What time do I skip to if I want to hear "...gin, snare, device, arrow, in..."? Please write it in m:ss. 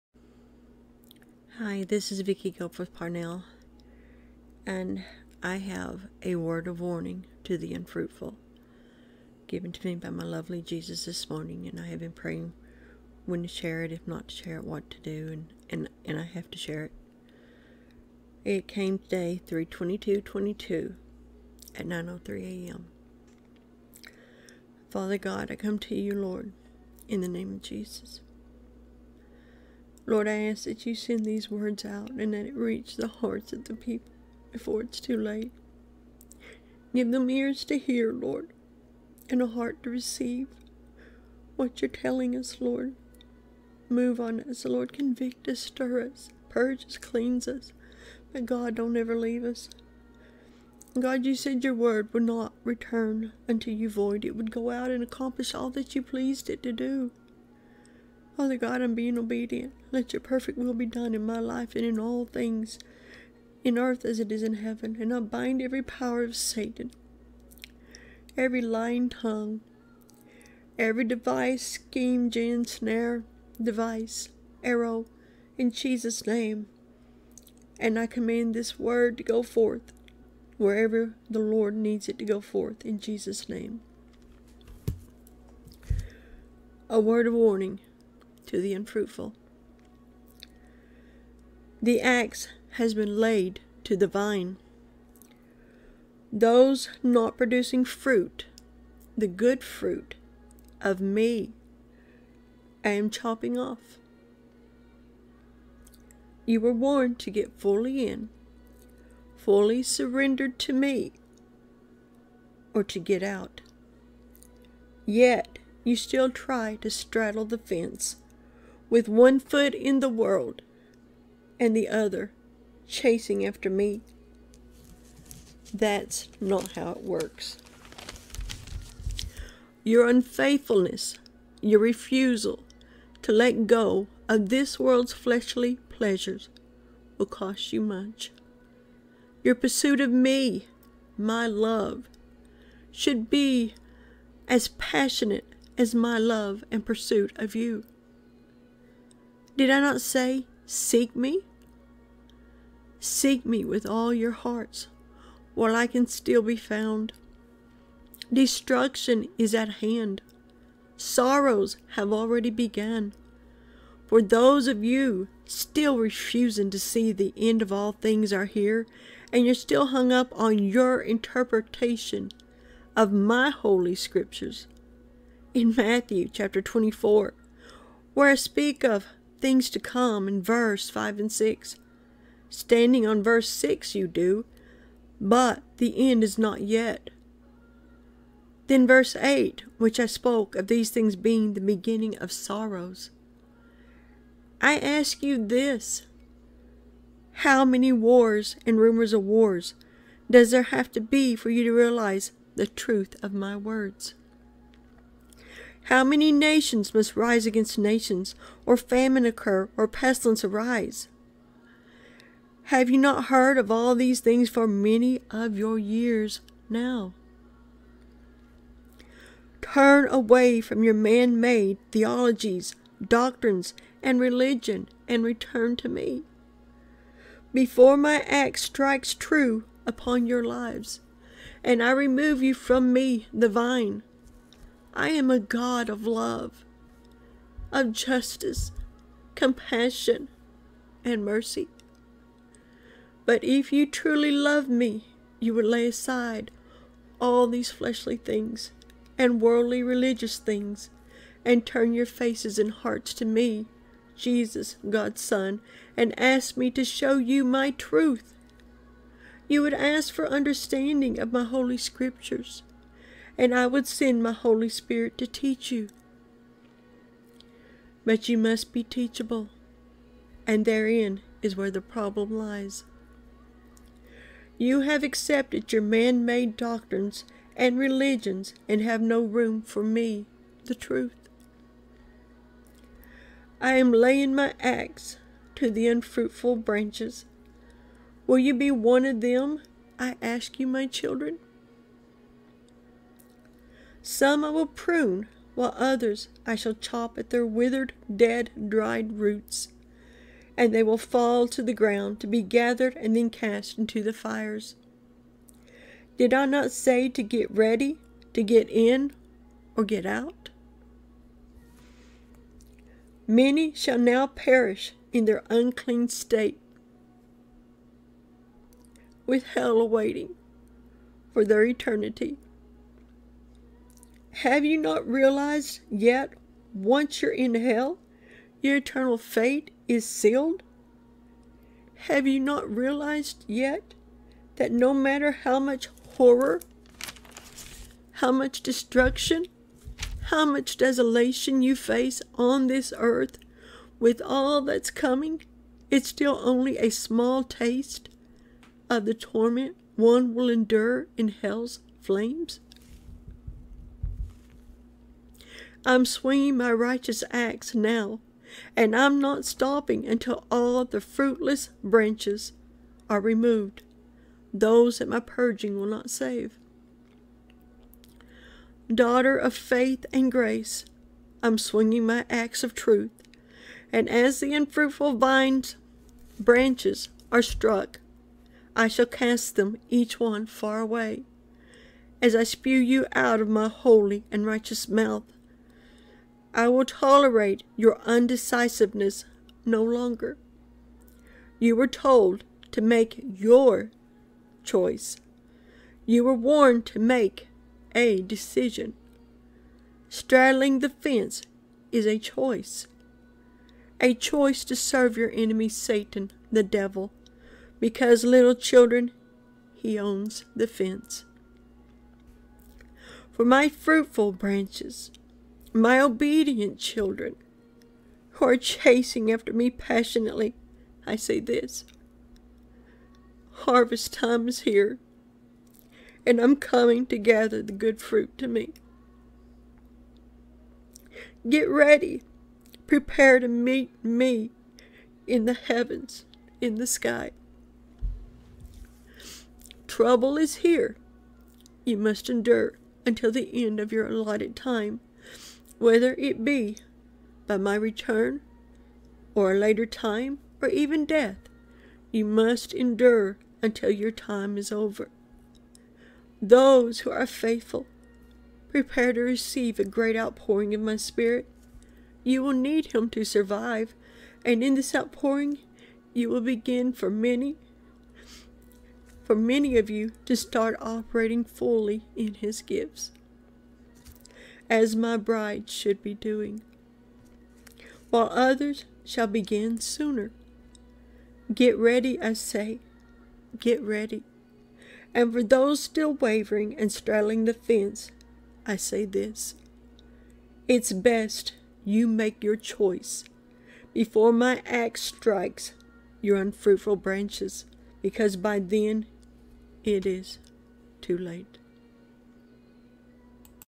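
1:12.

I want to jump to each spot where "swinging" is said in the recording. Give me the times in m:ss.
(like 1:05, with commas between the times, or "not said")
5:56, 6:11.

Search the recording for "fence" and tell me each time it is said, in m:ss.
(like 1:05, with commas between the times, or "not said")
1:57, 6:40, 6:50, 8:07.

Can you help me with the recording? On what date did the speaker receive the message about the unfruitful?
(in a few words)
3-22-22.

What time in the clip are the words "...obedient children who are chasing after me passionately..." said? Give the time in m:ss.
6:55.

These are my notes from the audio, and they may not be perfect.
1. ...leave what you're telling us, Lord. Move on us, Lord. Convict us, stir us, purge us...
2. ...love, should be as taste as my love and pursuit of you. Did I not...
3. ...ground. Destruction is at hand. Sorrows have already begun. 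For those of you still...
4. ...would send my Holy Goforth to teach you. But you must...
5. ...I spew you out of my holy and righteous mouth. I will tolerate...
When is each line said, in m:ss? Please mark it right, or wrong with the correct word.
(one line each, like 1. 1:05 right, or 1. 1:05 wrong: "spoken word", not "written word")
1. 0:39 wrong: "receive", not "leave"
2. 2:21 wrong: "passionate", not "taste"
3. 2:36 wrong: "found", not "ground"
4. 4:23 wrong: "Spirit", not "Goforth"
5. 6:22 right.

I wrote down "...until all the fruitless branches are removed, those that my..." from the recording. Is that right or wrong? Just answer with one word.
right.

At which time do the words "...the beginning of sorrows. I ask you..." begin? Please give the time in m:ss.
3:11.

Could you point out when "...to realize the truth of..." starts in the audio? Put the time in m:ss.
3:21.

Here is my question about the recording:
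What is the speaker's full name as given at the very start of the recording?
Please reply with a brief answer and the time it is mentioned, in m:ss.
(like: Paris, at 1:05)
Vicki Goforth Parnell, at 0:02.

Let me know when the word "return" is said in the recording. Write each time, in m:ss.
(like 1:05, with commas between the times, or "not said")
0:52, 3:45, 7:27.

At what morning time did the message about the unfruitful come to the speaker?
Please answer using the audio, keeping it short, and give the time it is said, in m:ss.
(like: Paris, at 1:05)
9:03 a.m., at 0:21.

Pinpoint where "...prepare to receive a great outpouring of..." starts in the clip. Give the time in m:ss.
7:38.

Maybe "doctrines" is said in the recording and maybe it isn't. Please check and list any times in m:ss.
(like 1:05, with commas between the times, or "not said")
3:43, 4:36.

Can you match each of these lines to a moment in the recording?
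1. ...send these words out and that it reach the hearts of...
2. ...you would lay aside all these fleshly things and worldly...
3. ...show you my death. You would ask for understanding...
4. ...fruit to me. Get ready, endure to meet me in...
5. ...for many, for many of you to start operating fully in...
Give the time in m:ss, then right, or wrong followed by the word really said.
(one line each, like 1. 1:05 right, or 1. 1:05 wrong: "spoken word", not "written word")
1. 0:30 right
2. 4:05 right
3. 4:16 wrong: "truth", not "death"
4. 7:08 wrong: "prepare", not "endure"
5. 7:46 right.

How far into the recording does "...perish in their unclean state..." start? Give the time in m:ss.
5:14.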